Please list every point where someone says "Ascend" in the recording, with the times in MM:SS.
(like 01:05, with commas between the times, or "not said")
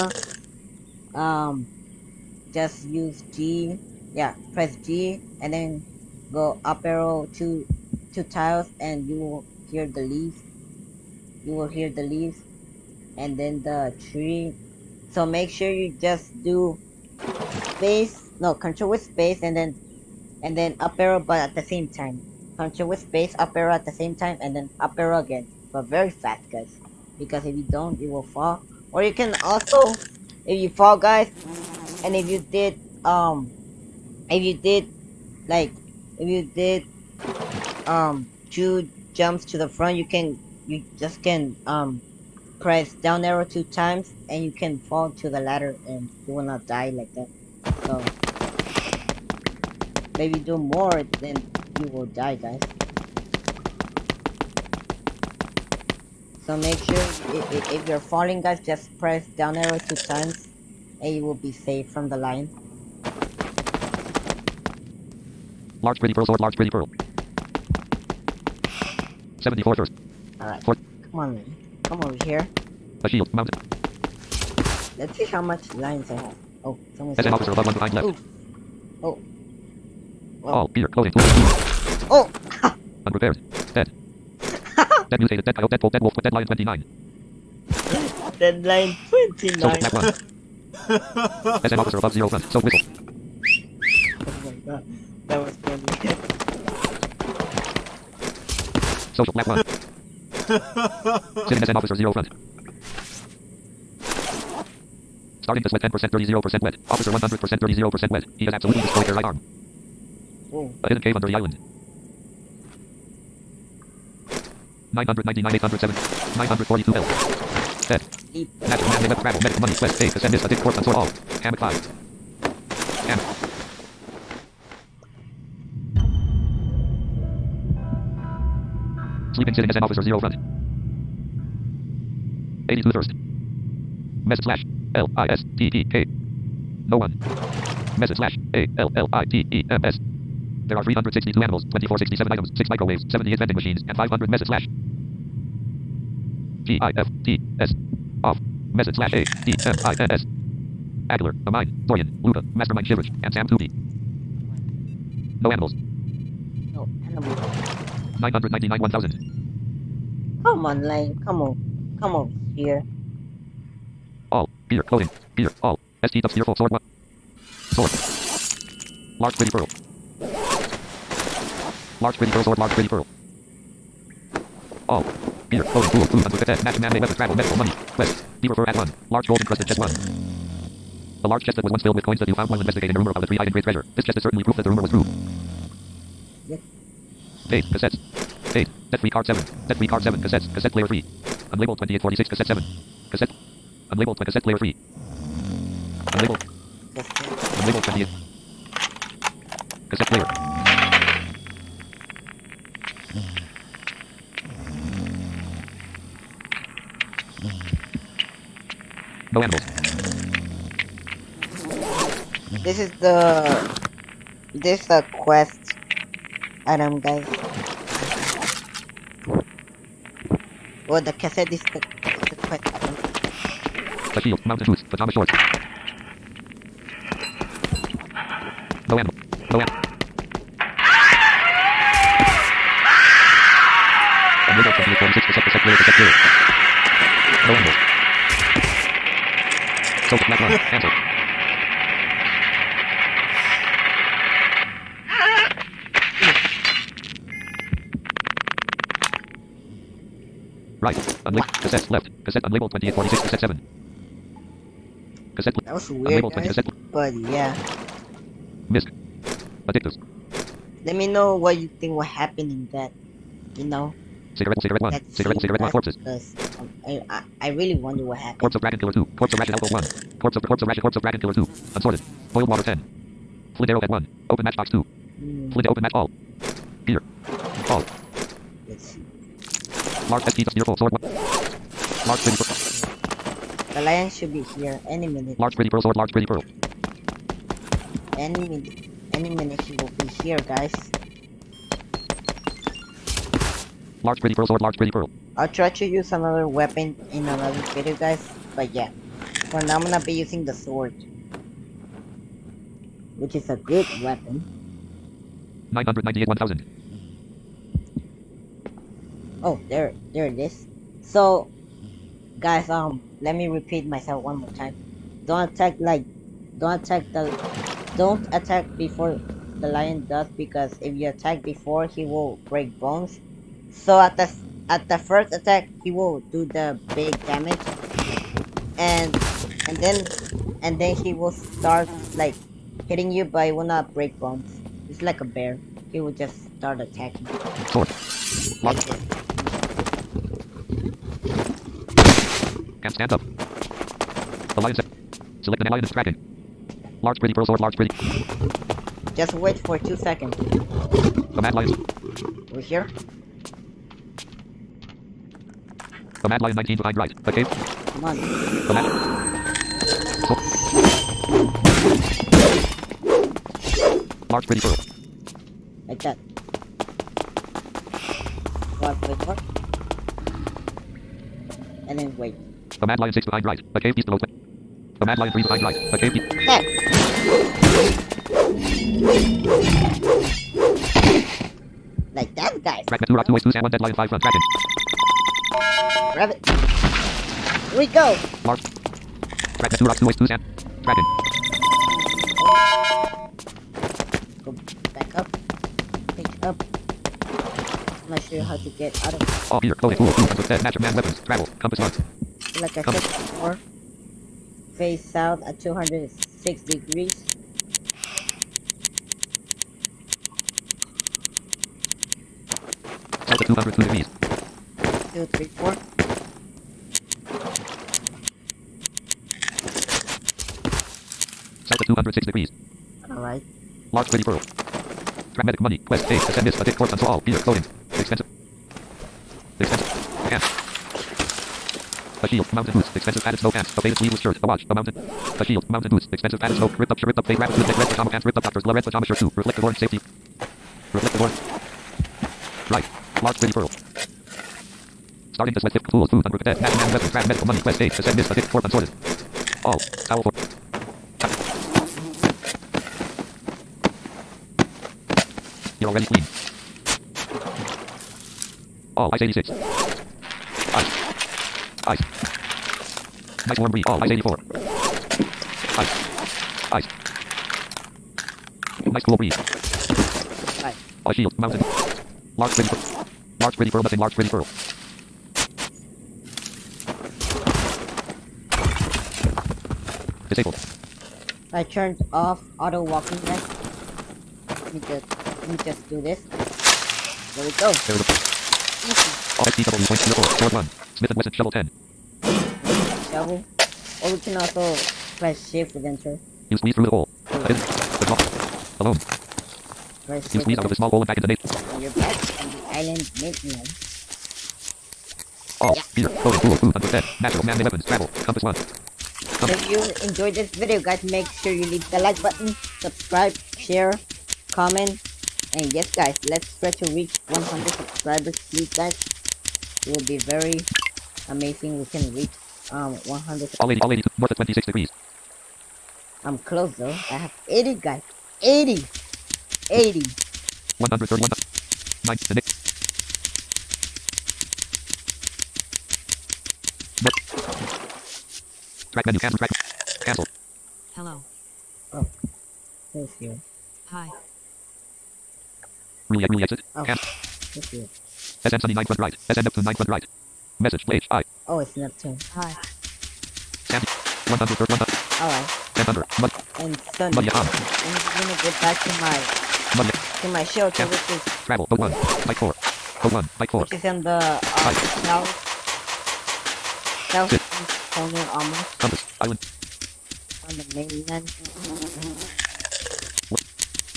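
07:06, 07:27.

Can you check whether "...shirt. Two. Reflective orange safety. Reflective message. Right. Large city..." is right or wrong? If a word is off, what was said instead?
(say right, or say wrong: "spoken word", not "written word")
wrong: "orange", not "message".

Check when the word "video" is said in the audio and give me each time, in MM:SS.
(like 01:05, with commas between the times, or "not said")
04:57, 08:30.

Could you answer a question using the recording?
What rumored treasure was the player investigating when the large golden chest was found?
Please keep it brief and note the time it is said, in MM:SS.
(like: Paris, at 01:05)
three-eyed great treasure, at 03:03.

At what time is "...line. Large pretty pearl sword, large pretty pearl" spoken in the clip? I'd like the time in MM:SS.
01:02.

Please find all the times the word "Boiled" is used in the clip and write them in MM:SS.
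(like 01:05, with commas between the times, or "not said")
04:32.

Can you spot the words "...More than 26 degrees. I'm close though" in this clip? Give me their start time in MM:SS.
08:44.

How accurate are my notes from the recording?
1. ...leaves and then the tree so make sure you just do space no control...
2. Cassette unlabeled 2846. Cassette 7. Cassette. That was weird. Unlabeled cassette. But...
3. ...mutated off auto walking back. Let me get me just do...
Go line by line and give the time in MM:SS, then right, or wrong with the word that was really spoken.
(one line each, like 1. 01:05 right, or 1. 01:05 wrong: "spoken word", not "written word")
1. 00:12 right
2. 04:12 right
3. 08:01 wrong: "turned", not "mutated".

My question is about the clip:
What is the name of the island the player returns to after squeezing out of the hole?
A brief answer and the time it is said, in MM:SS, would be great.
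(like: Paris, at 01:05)
Midland, at 08:22.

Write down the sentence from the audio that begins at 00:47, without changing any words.
So, maybe do more, then you will die, guys.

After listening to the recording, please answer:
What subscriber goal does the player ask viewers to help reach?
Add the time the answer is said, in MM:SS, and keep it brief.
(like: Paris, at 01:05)
100 subscribers, at 08:37.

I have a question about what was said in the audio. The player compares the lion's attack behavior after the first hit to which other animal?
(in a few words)
bear.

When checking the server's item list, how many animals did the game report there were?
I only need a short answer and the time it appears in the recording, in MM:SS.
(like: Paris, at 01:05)
362, at 02:20.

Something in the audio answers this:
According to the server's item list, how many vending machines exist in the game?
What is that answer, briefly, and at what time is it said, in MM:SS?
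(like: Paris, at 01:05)
78, at 02:23.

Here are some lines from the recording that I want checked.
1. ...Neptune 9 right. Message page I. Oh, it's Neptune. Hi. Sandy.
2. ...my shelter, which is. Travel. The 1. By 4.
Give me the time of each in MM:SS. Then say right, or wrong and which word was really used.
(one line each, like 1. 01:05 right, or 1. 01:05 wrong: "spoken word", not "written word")
1. 09:09 right
2. 09:20 right.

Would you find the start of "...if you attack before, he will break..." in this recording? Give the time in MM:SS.
05:20.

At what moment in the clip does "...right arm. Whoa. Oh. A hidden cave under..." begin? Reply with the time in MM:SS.
01:49.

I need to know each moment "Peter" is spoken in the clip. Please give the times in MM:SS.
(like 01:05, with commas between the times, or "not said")
01:20, 07:07.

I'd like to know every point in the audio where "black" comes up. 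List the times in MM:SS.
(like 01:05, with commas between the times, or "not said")
01:29, 01:39.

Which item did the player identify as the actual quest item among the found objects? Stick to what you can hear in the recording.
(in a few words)
the cassette.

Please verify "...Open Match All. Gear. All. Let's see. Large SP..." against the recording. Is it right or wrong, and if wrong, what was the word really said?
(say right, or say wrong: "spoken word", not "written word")
right.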